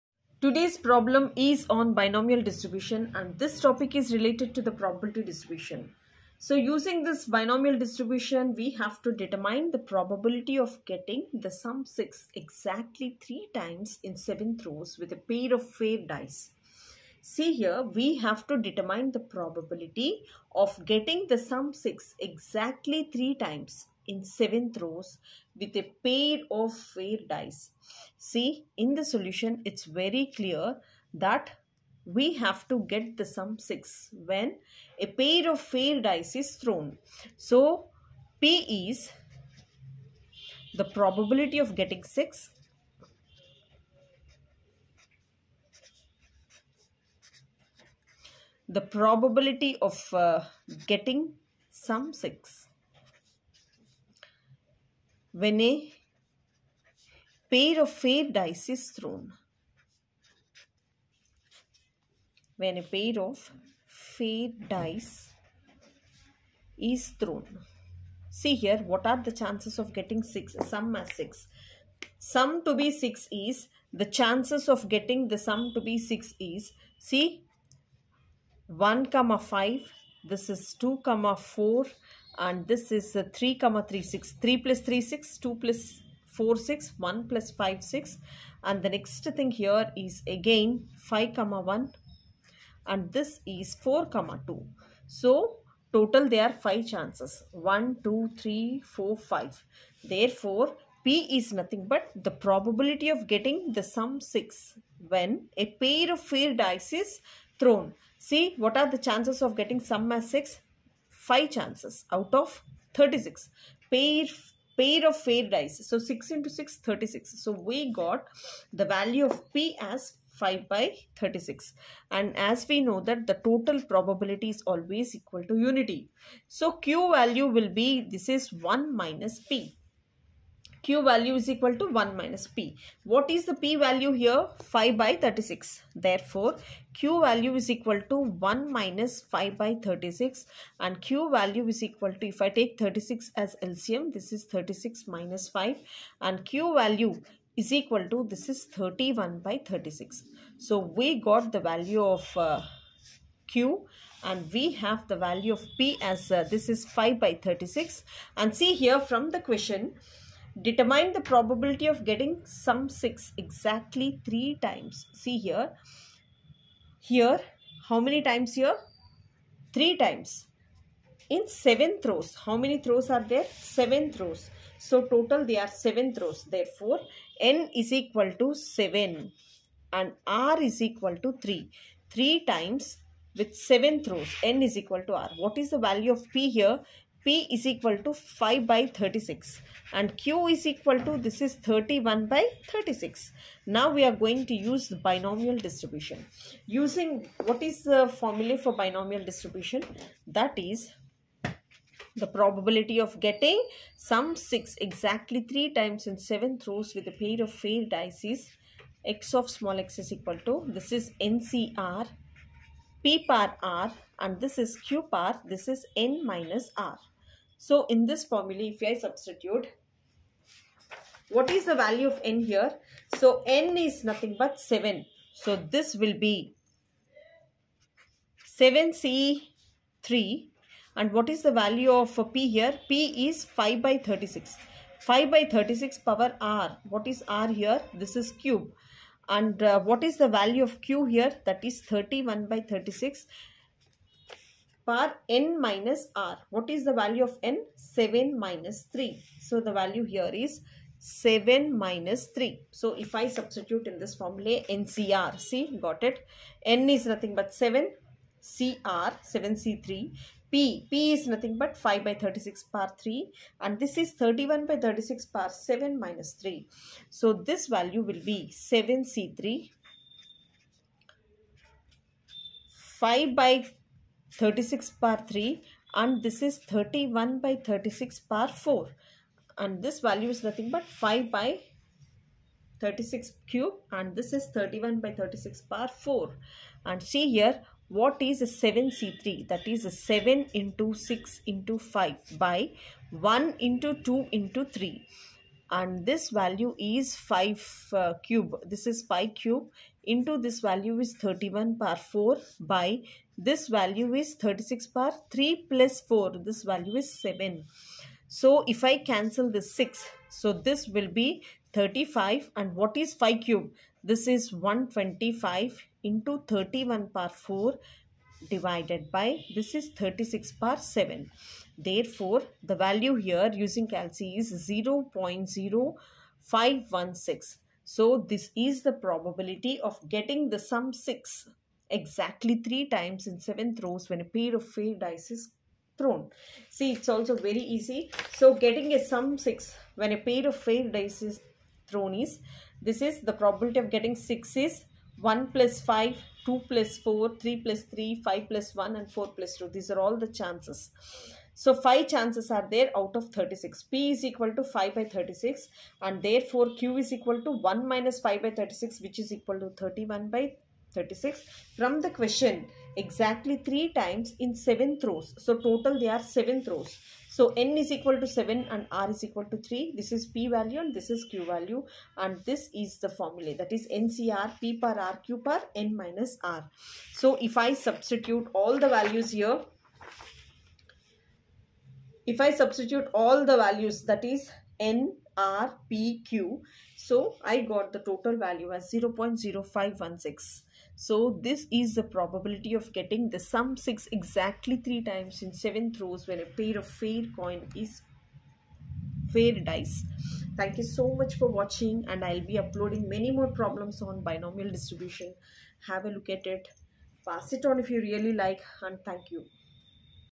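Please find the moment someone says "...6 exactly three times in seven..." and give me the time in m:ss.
5:30.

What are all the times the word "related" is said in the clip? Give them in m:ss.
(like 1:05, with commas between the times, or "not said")
0:04.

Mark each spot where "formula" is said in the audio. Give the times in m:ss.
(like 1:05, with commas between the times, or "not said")
3:18, 3:38, 4:14, 6:13.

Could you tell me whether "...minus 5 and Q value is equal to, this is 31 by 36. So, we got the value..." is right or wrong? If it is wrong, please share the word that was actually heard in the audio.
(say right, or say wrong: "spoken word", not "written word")
right.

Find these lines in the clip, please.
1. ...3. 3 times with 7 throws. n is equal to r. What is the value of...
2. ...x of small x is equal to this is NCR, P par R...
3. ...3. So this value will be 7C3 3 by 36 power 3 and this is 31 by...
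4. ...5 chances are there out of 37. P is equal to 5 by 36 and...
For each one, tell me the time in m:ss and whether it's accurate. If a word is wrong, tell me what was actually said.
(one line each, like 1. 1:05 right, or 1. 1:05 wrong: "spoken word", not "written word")
1. 3:01 right
2. 3:29 right
3. 4:26 wrong: "5", not "3"
4. 5:51 wrong: "36", not "37".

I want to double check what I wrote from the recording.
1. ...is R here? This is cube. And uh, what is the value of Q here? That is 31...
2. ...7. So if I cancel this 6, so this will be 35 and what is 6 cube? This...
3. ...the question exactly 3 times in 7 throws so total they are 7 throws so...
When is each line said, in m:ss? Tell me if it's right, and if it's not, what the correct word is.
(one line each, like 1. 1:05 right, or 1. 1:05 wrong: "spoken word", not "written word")
1. 3:57 right
2. 5:07 wrong: "5", not "6"
3. 6:02 right.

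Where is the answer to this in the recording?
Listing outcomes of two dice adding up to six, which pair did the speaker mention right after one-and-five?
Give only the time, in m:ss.
1:20.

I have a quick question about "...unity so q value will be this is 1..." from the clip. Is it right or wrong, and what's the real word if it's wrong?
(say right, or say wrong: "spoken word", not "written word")
right.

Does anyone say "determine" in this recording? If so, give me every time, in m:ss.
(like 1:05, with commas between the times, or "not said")
0:09, 0:18, 2:40.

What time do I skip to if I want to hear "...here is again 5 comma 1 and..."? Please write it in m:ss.
1:29.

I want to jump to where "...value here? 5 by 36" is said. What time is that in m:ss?
2:13.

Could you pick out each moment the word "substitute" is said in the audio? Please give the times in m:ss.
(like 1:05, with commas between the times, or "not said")
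3:38, 4:13, 6:17, 6:22.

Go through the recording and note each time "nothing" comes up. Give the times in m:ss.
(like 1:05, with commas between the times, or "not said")
1:41, 3:44, 4:17, 4:21, 4:40.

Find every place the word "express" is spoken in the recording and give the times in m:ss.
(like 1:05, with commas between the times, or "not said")
not said.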